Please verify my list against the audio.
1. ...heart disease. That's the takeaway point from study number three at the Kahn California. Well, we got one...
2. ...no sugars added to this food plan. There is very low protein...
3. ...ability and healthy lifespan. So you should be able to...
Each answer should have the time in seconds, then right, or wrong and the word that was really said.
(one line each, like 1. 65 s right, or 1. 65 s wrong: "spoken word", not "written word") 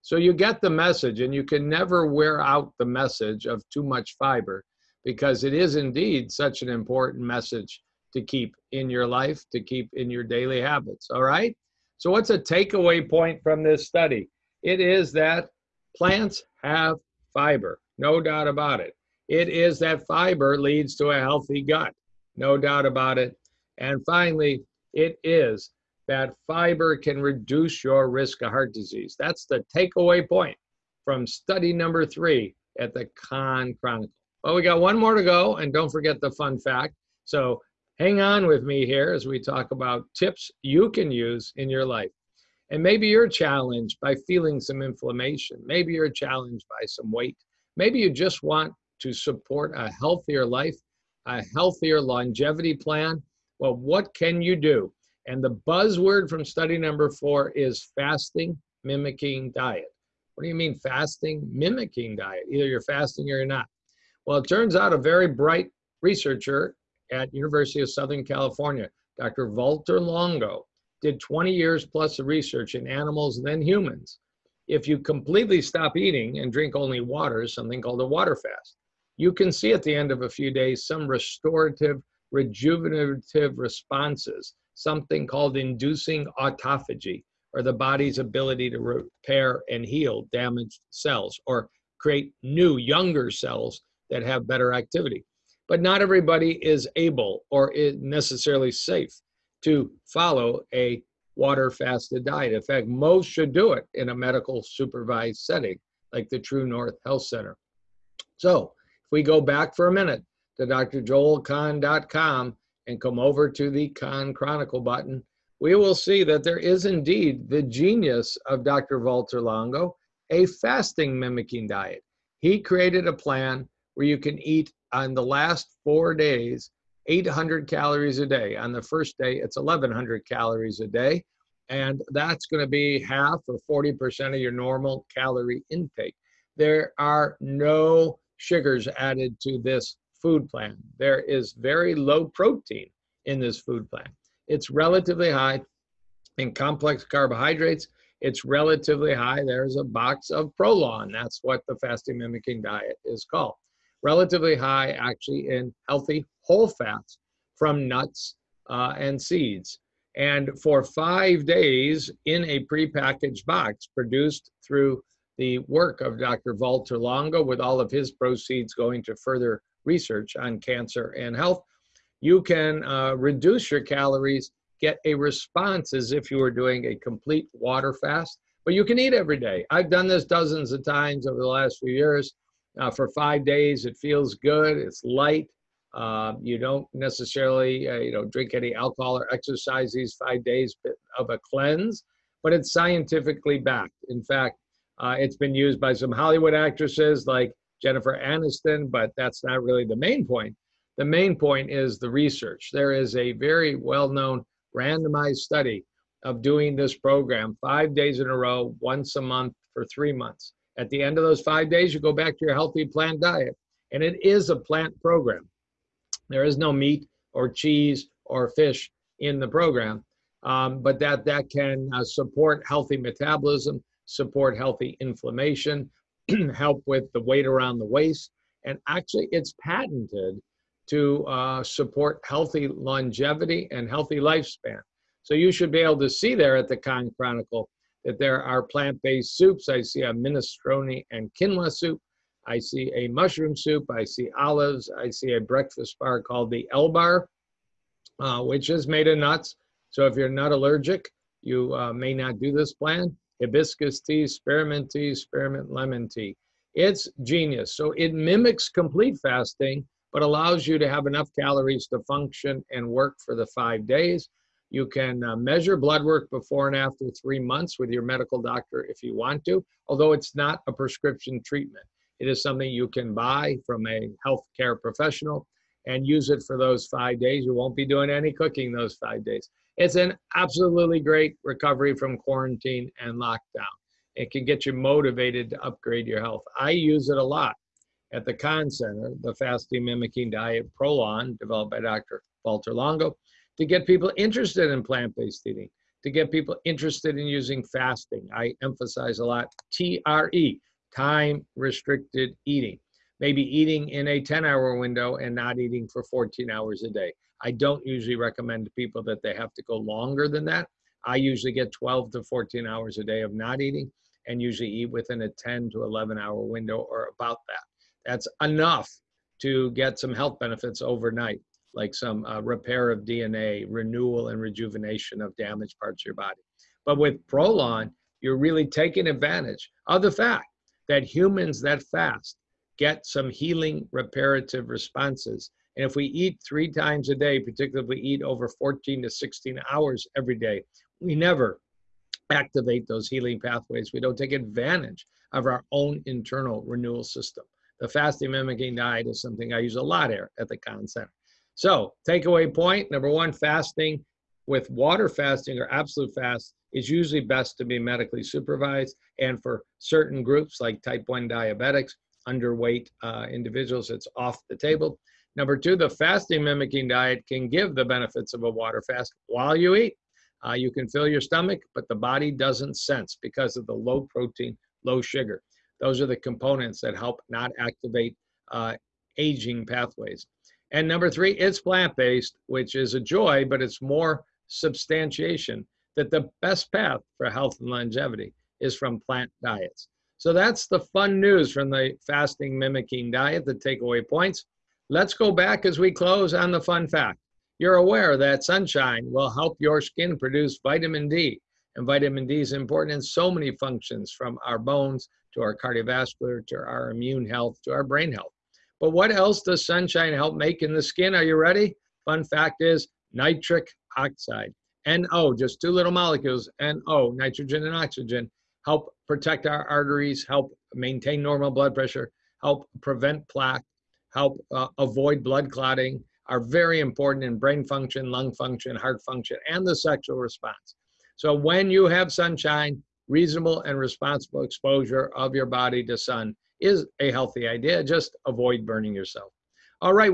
1. 28 s wrong: "Chronicle", not "California"
2. 137 s right
3. 232 s wrong: "longevity", not "ability".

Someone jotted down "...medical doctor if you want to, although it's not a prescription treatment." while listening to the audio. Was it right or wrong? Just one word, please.
right.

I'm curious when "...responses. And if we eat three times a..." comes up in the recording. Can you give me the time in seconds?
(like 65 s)
334 s.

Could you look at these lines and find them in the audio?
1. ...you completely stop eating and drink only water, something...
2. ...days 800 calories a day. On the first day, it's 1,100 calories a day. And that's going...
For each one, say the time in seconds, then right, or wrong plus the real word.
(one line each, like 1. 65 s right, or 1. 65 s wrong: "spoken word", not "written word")
1. 74 s right
2. 126 s right.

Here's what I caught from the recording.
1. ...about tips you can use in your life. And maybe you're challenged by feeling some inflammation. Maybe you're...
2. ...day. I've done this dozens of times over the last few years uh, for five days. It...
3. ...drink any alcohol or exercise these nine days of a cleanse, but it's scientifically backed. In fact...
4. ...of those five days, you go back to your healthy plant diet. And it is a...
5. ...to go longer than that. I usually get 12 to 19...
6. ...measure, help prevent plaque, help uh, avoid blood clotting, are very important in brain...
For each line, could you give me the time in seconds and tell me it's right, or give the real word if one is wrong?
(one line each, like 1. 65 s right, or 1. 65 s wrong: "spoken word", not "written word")
1. 39 s right
2. 179 s right
3. 188 s wrong: "five", not "nine"
4. 211 s right
5. 309 s wrong: "14", not "19"
6. 421 s wrong: "pressure", not "measure".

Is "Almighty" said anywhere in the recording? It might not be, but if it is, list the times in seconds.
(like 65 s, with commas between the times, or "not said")
not said.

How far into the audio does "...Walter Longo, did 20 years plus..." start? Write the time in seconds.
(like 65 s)
69 s.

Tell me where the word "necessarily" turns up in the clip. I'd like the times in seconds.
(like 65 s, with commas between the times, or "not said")
97 s, 186 s.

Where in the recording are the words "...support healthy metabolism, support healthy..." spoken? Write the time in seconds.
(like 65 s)
222 s.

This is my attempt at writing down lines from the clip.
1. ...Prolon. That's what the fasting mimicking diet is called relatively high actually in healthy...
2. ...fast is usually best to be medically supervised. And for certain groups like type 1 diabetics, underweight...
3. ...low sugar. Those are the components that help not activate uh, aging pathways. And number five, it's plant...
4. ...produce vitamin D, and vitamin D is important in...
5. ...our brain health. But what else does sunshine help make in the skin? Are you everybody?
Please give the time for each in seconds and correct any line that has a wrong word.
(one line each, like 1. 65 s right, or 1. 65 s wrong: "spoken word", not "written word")
1. 150 s right
2. 356 s right
3. 374 s wrong: "three", not "five"
4. 400 s right
5. 407 s wrong: "ready", not "everybody".